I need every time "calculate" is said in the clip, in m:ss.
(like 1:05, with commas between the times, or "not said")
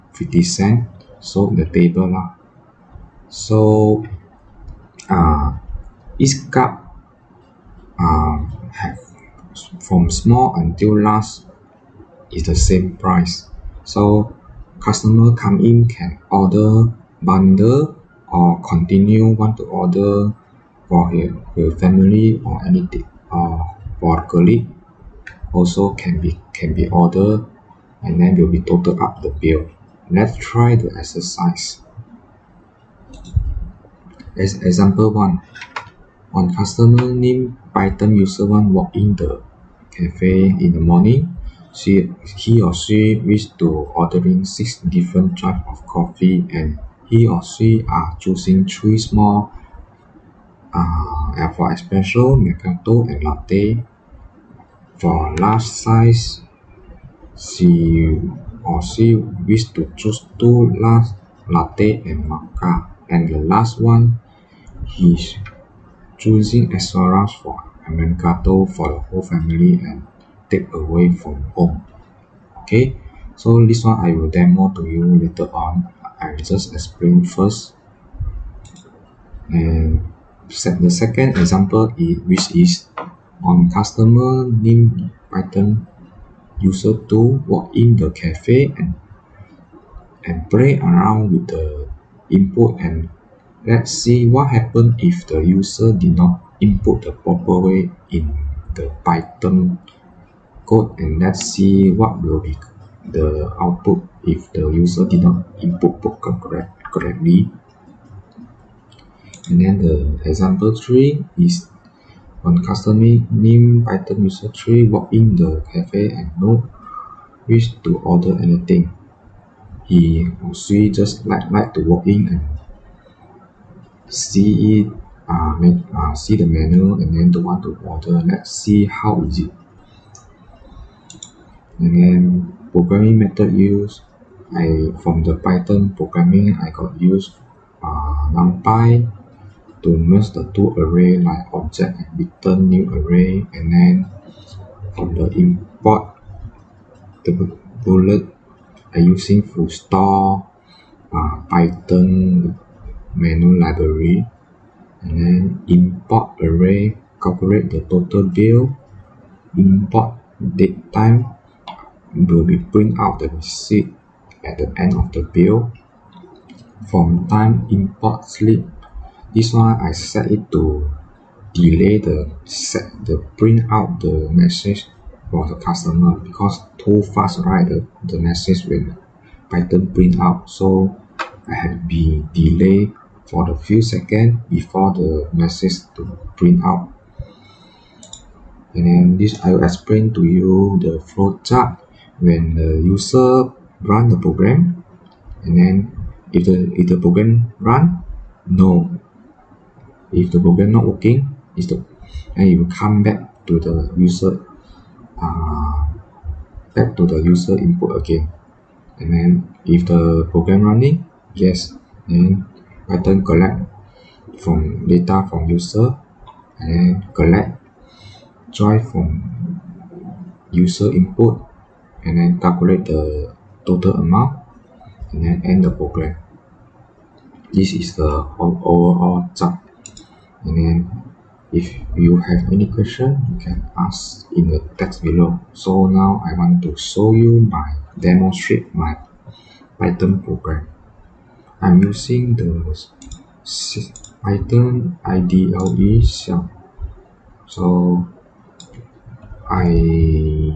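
2:37, 3:42.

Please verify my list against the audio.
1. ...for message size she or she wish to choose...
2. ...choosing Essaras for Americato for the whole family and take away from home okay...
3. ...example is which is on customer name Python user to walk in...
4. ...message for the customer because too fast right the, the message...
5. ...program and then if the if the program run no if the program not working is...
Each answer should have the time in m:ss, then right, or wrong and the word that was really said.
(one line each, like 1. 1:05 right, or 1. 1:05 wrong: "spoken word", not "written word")
1. 0:54 wrong: "large", not "message"
2. 1:06 right
3. 1:21 right
4. 2:54 right
5. 3:14 right.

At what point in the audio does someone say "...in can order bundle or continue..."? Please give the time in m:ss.
0:15.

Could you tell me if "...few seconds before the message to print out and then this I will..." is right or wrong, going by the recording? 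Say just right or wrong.
right.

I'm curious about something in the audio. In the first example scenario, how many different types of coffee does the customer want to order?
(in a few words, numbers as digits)
6.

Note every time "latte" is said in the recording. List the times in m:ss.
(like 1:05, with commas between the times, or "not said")
0:53, 1:01.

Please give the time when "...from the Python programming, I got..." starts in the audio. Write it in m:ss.
2:15.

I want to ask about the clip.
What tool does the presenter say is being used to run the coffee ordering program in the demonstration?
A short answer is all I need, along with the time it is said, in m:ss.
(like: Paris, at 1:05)
Python IDLE shell, at 4:04.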